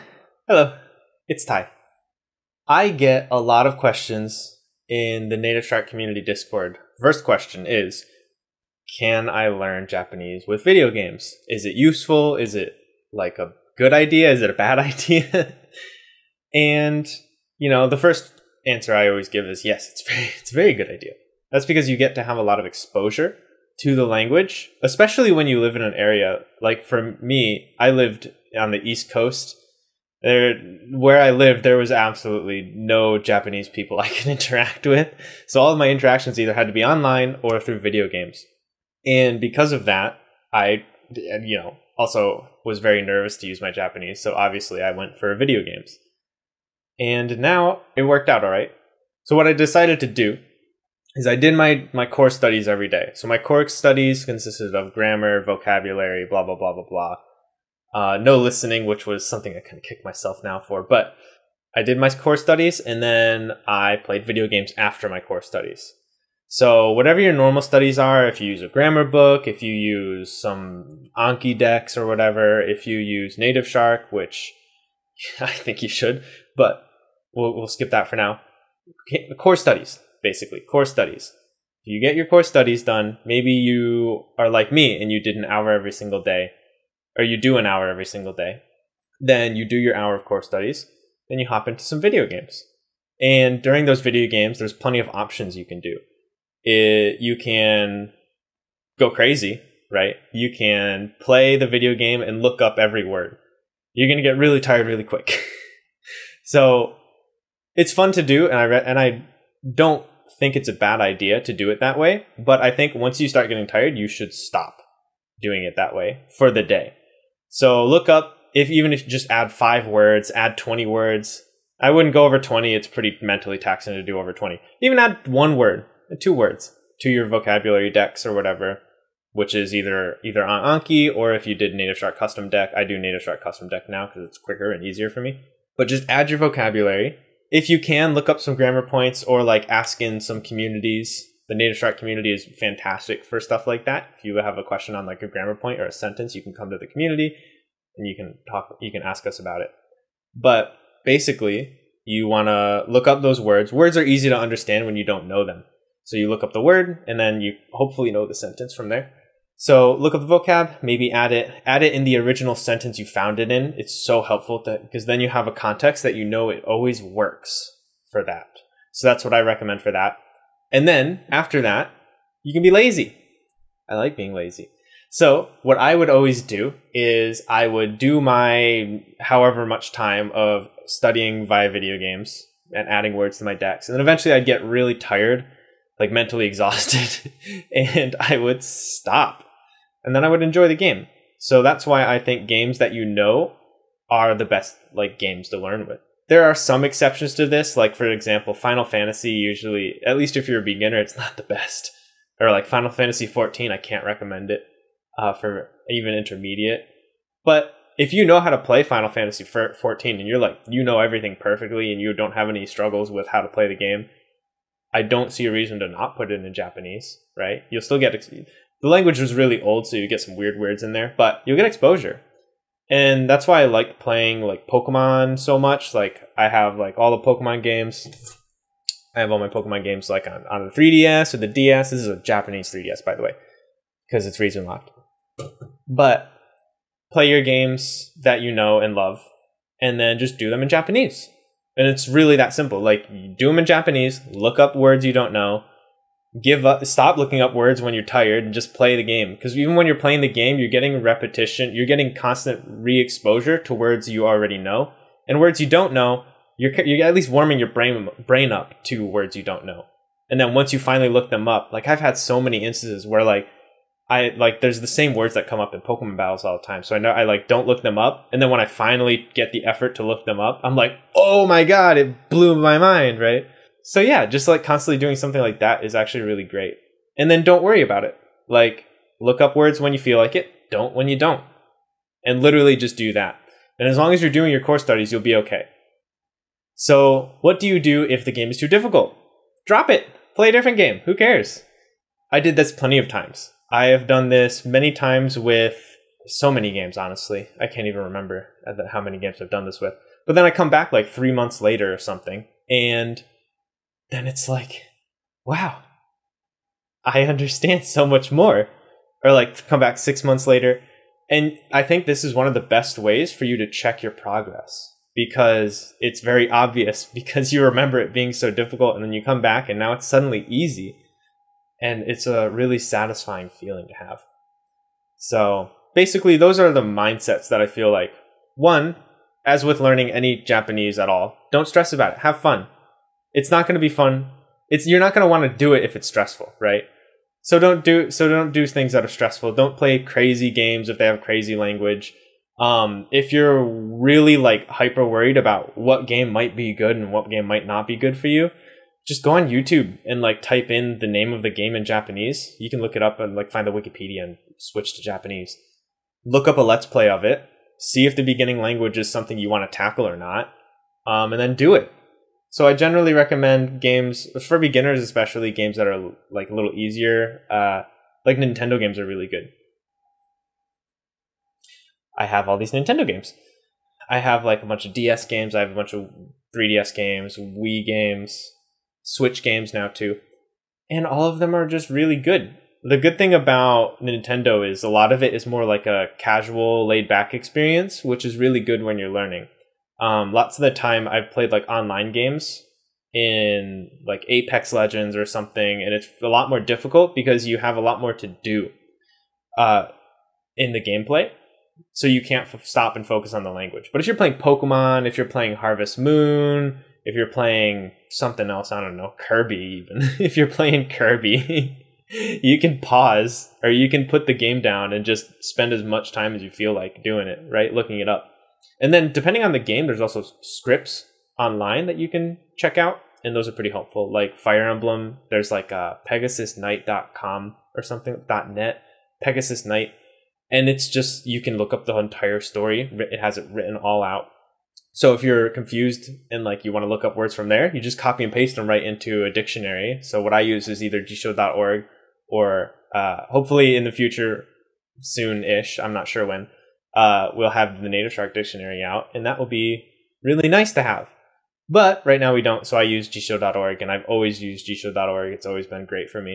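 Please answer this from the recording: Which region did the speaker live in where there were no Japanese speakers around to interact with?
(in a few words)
East Coast.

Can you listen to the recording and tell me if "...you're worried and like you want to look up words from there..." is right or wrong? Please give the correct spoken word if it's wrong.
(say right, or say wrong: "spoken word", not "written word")
wrong: "confused", not "worried".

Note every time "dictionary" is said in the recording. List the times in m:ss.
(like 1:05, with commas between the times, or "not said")
7:19, 7:28.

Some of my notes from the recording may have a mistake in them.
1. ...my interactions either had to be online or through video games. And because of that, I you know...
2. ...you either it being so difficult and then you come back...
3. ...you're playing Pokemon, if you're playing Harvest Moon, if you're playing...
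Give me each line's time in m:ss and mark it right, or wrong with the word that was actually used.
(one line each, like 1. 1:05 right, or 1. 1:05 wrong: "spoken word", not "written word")
1. 0:35 right
2. 5:17 wrong: "remember", not "either"
3. 6:44 right.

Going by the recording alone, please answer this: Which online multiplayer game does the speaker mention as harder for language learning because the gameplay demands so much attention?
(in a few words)
Apex Legends.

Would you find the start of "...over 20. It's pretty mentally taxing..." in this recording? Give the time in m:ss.
2:02.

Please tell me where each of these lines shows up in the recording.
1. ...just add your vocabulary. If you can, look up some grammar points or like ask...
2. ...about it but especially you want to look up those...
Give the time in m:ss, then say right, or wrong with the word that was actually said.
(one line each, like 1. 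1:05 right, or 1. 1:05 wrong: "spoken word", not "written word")
1. 2:15 right
2. 2:29 wrong: "basically", not "especially".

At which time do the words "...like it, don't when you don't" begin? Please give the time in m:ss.
4:40.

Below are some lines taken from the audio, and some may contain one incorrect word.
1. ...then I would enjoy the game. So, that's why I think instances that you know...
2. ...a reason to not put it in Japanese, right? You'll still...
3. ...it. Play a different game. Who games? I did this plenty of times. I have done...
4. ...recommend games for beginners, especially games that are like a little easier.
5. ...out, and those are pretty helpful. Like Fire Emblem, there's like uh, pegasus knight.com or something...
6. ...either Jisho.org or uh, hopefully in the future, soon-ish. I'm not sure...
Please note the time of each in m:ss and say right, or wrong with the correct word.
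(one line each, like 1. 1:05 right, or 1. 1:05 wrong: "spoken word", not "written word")
1. 3:10 wrong: "games", not "instances"
2. 3:35 right
3. 4:49 wrong: "cares", not "games"
4. 6:03 right
5. 7:02 right
6. 7:20 right.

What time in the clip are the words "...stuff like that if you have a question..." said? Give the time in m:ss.
2:23.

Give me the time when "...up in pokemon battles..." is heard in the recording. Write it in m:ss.
4:25.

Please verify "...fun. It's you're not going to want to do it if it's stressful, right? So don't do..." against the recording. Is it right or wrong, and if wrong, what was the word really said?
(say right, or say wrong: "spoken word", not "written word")
right.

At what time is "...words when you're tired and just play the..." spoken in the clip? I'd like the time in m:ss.
4:07.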